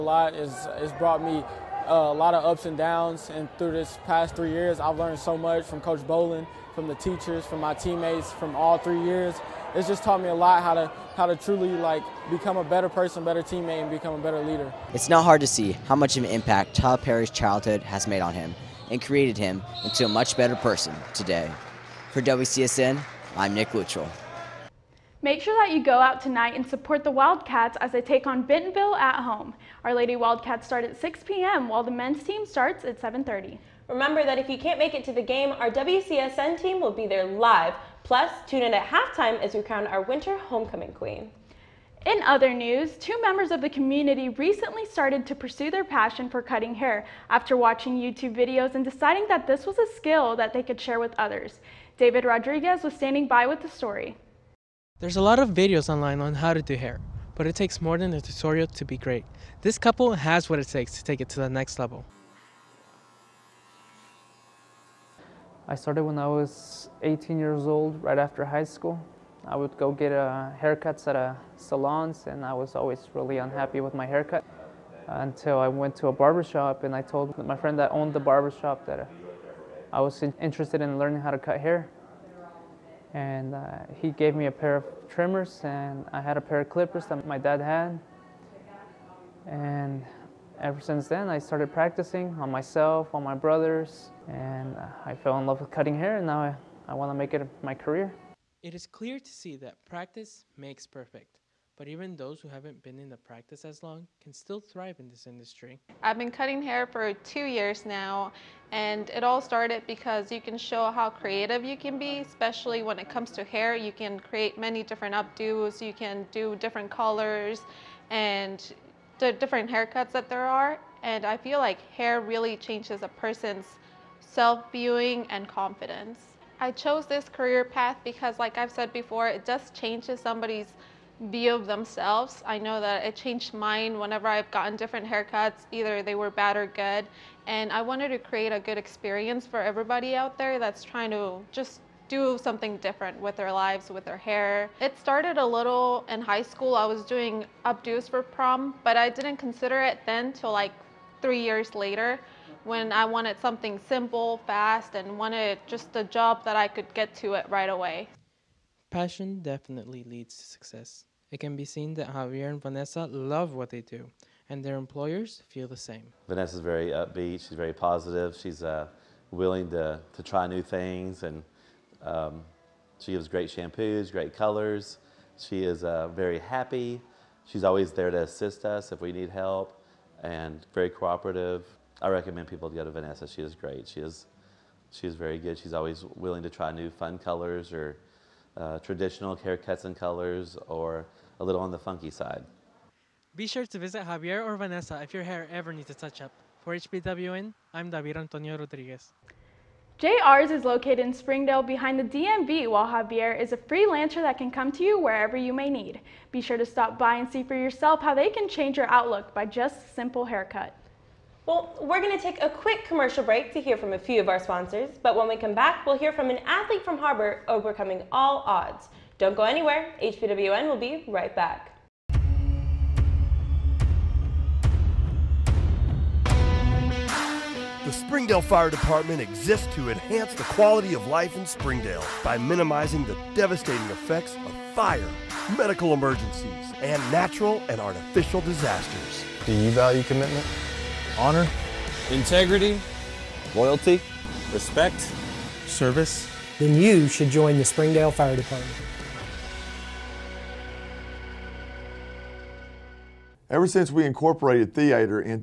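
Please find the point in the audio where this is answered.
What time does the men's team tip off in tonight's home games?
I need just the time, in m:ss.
0:33.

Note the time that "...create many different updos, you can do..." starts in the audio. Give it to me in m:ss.
1:54.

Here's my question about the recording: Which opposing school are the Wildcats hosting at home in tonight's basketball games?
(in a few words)
Bentonville.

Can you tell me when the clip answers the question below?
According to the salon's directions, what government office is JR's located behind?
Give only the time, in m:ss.
3:22.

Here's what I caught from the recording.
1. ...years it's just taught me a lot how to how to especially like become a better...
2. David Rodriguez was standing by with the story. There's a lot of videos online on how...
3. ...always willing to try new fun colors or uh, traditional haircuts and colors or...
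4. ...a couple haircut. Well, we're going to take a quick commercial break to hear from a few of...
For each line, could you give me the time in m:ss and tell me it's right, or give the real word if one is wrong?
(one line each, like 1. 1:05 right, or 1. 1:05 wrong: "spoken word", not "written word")
1. 0:09 wrong: "truly", not "especially"
2. 0:51 right
3. 3:05 right
4. 3:29 wrong: "simple", not "couple".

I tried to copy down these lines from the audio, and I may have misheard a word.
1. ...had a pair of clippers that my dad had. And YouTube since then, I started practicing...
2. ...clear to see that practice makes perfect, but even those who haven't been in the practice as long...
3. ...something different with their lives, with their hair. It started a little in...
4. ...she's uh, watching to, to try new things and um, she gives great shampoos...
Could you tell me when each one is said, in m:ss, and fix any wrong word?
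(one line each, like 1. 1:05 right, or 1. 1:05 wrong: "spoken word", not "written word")
1. 1:26 wrong: "Ever", not "YouTube"
2. 1:38 right
3. 2:22 right
4. 2:48 wrong: "willing", not "watching".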